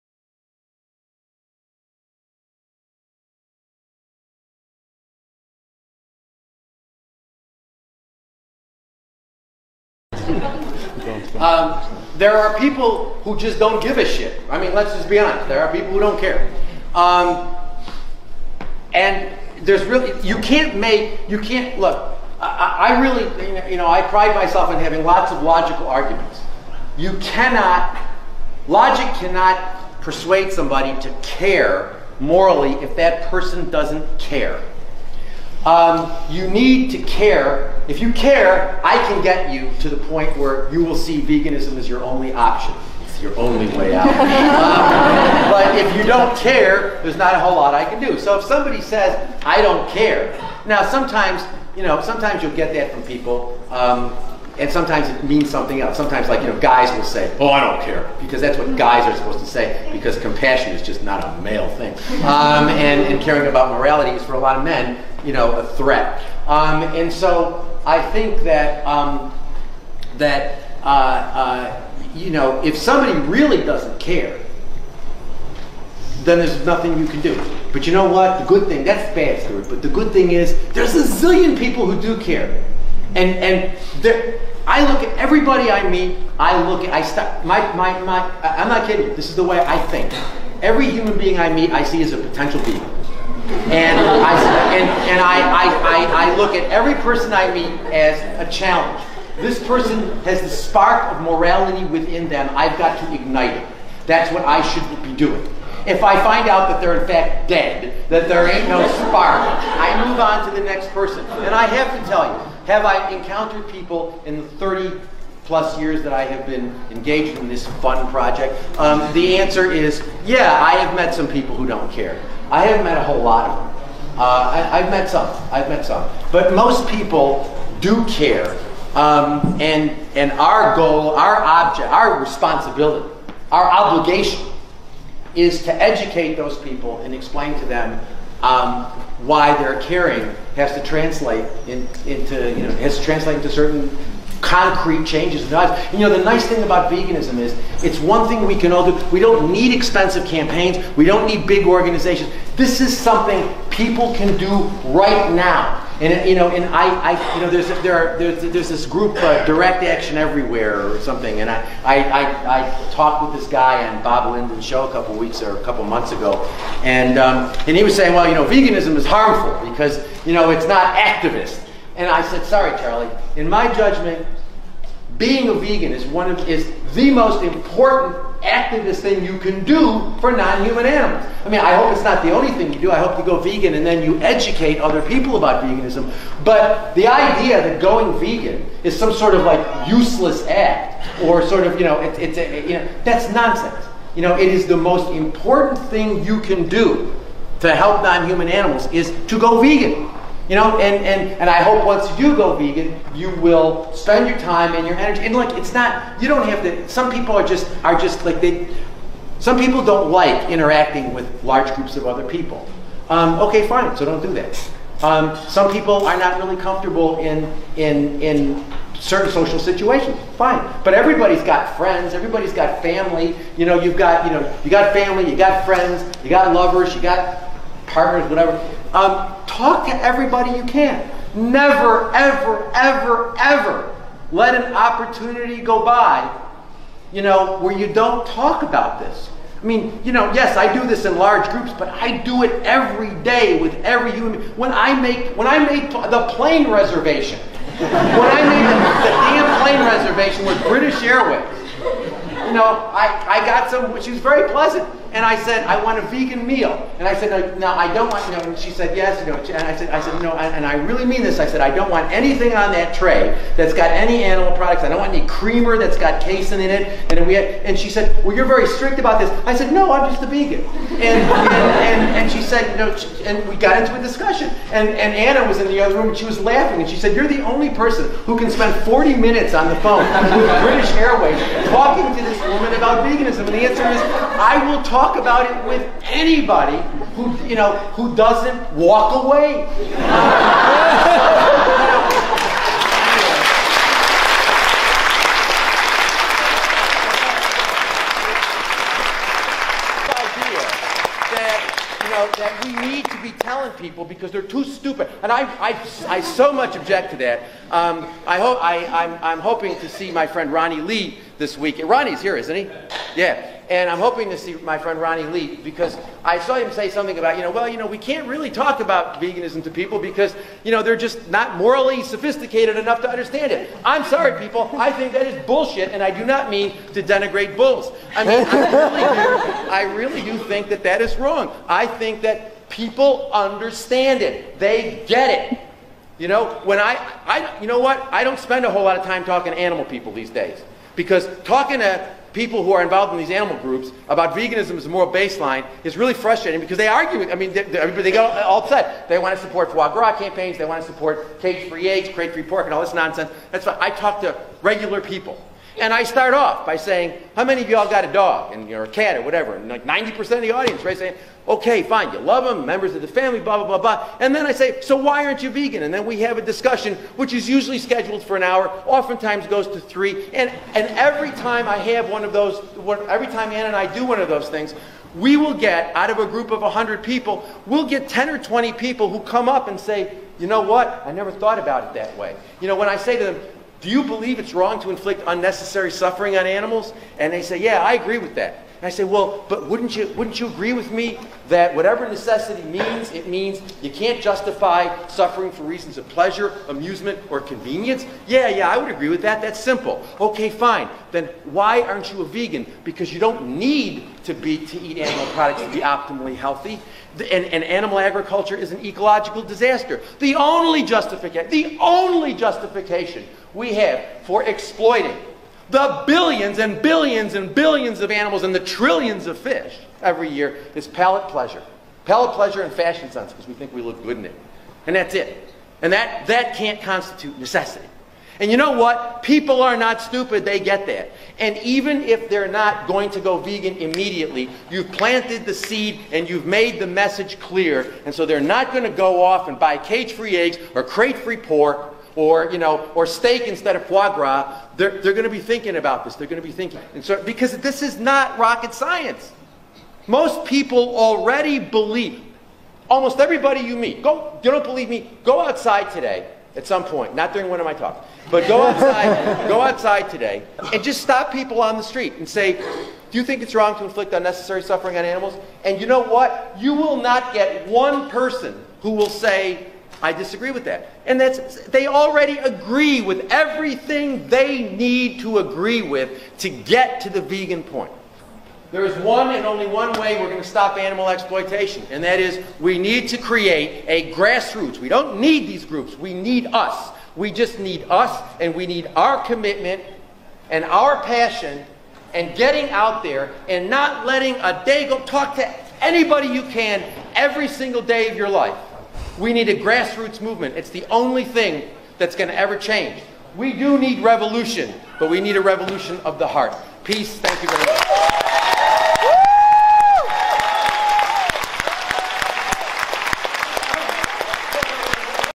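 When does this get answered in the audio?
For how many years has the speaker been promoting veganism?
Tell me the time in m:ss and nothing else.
1:54.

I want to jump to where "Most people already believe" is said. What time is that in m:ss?
7:30.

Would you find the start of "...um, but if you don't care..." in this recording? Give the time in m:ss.
0:44.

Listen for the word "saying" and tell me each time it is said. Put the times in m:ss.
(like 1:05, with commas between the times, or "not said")
2:47, 5:56, 6:00.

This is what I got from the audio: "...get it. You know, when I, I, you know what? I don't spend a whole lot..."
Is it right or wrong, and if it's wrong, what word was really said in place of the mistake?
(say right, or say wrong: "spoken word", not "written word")
right.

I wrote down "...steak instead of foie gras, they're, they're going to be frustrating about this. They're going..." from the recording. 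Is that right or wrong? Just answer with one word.
wrong.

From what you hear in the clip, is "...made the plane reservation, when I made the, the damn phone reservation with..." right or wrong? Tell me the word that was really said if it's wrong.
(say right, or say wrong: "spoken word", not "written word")
wrong: "plane", not "phone".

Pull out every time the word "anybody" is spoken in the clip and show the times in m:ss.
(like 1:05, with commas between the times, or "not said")
4:46, 8:15.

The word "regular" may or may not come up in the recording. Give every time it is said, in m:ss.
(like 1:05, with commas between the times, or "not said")
5:54.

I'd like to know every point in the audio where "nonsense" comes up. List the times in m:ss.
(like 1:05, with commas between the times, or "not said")
3:13, 5:52.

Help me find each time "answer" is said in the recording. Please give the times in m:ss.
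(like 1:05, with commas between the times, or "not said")
1:59, 4:43.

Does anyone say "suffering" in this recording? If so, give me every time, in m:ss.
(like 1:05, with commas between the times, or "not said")
6:25, 6:35, 7:44.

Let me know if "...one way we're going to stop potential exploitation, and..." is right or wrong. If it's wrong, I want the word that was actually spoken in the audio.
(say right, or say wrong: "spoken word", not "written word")
wrong: "animal", not "potential".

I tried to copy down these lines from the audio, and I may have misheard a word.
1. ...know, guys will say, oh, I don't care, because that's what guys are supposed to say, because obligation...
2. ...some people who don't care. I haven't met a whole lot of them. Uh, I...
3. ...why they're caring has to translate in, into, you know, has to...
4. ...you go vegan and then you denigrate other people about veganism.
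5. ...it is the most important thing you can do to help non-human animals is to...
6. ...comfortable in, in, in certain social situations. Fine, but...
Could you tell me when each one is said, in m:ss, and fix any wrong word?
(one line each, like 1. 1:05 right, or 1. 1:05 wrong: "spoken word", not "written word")
1. 0:56 wrong: "compassion", not "obligation"
2. 2:01 right
3. 2:19 right
4. 3:03 wrong: "educate", not "denigrate"
5. 3:14 right
6. 3:36 right.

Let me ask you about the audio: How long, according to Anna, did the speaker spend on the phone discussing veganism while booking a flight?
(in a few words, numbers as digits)
40 minutes.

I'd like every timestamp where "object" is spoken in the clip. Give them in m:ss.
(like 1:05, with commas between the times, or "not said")
2:11, 5:06.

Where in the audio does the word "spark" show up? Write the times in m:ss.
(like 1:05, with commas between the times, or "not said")
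1:40, 1:48.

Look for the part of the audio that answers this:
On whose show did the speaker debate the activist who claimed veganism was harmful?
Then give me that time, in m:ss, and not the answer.
2:44.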